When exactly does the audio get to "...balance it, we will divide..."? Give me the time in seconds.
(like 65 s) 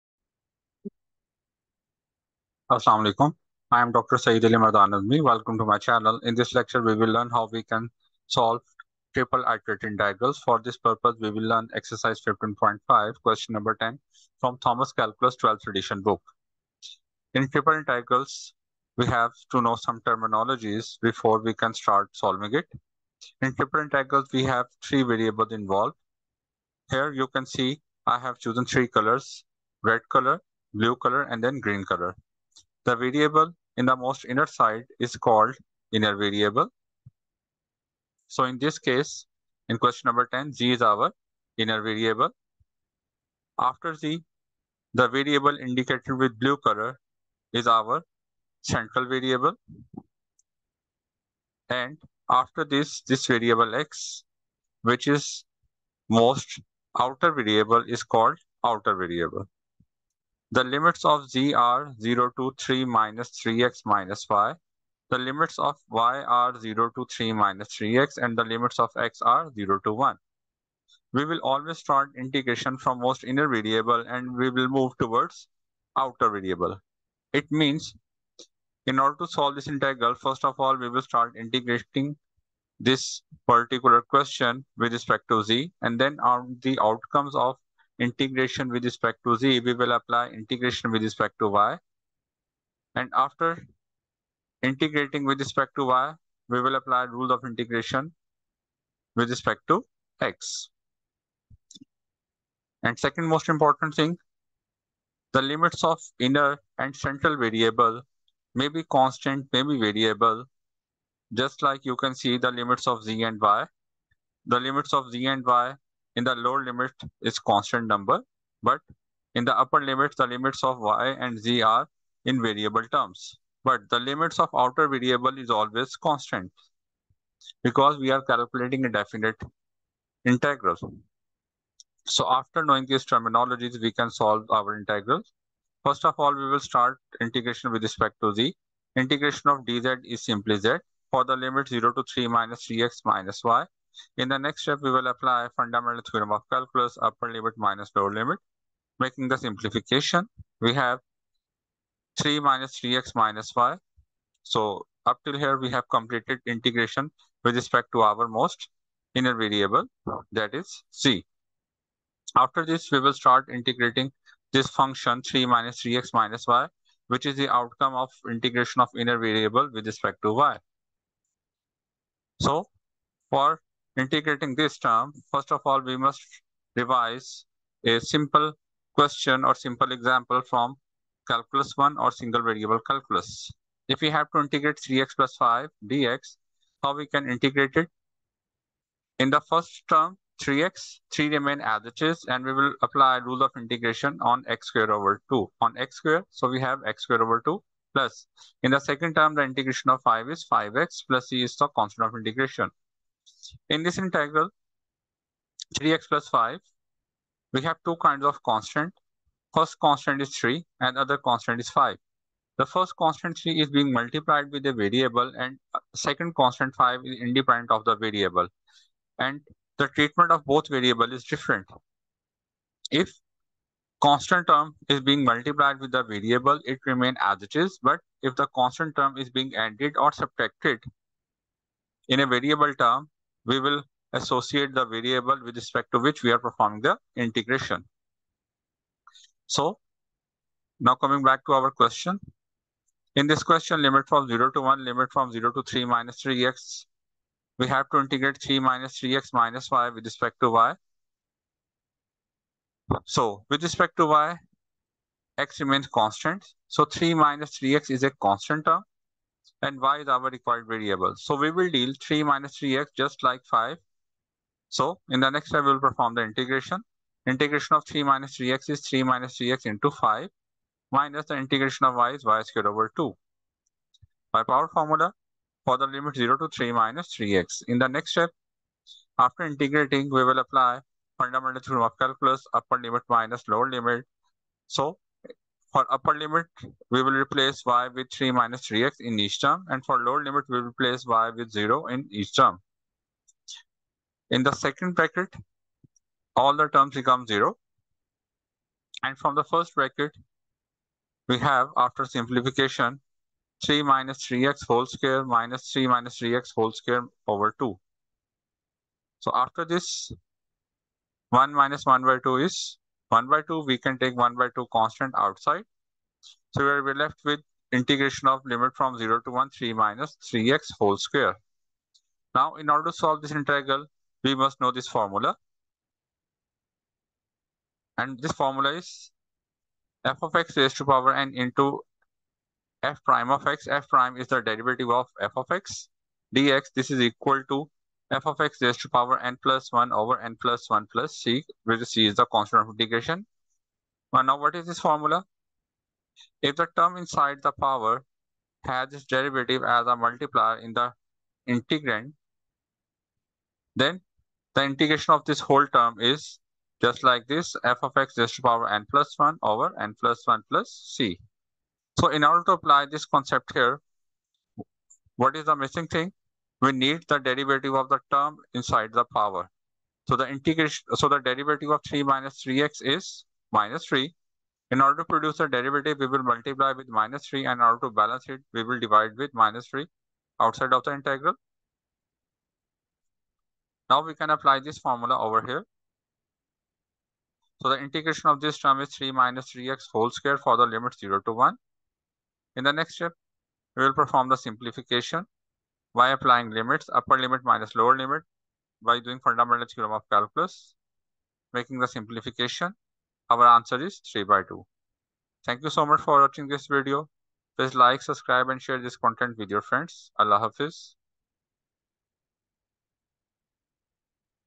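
377 s.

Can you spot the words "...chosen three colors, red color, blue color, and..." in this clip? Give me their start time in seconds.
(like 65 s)
28 s.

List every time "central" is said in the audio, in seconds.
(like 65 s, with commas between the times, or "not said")
48 s, 106 s.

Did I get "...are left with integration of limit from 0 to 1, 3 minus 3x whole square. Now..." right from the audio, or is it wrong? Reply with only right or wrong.
right.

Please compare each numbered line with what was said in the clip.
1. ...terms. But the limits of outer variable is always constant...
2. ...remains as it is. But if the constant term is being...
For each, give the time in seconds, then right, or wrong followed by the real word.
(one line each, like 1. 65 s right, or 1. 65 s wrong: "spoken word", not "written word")
1. 122 s right
2. 226 s right.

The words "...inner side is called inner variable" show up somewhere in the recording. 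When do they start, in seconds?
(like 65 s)
34 s.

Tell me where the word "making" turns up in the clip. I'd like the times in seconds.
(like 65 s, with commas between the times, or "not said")
148 s, 401 s.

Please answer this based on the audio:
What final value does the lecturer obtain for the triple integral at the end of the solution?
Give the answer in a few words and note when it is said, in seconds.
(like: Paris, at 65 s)
3/2, at 404 s.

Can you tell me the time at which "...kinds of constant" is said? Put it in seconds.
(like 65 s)
207 s.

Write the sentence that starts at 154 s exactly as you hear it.
So up till here, we have completed integration with respect to our most inner variable, that is z.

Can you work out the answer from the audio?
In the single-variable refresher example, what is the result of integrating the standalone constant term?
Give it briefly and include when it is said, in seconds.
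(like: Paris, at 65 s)
5x, at 200 s.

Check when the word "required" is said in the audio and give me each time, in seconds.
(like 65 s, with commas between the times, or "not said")
260 s.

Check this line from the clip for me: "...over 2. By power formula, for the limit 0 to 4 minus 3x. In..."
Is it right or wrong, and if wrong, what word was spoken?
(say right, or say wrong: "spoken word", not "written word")
wrong: "3", not "4".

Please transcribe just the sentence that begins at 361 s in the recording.
So in order to apply this concept here, what is the missing thing?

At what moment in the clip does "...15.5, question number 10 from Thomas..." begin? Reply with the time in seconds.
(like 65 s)
12 s.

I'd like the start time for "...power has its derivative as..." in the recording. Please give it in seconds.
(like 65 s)
347 s.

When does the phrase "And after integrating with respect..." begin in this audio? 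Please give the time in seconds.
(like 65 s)
92 s.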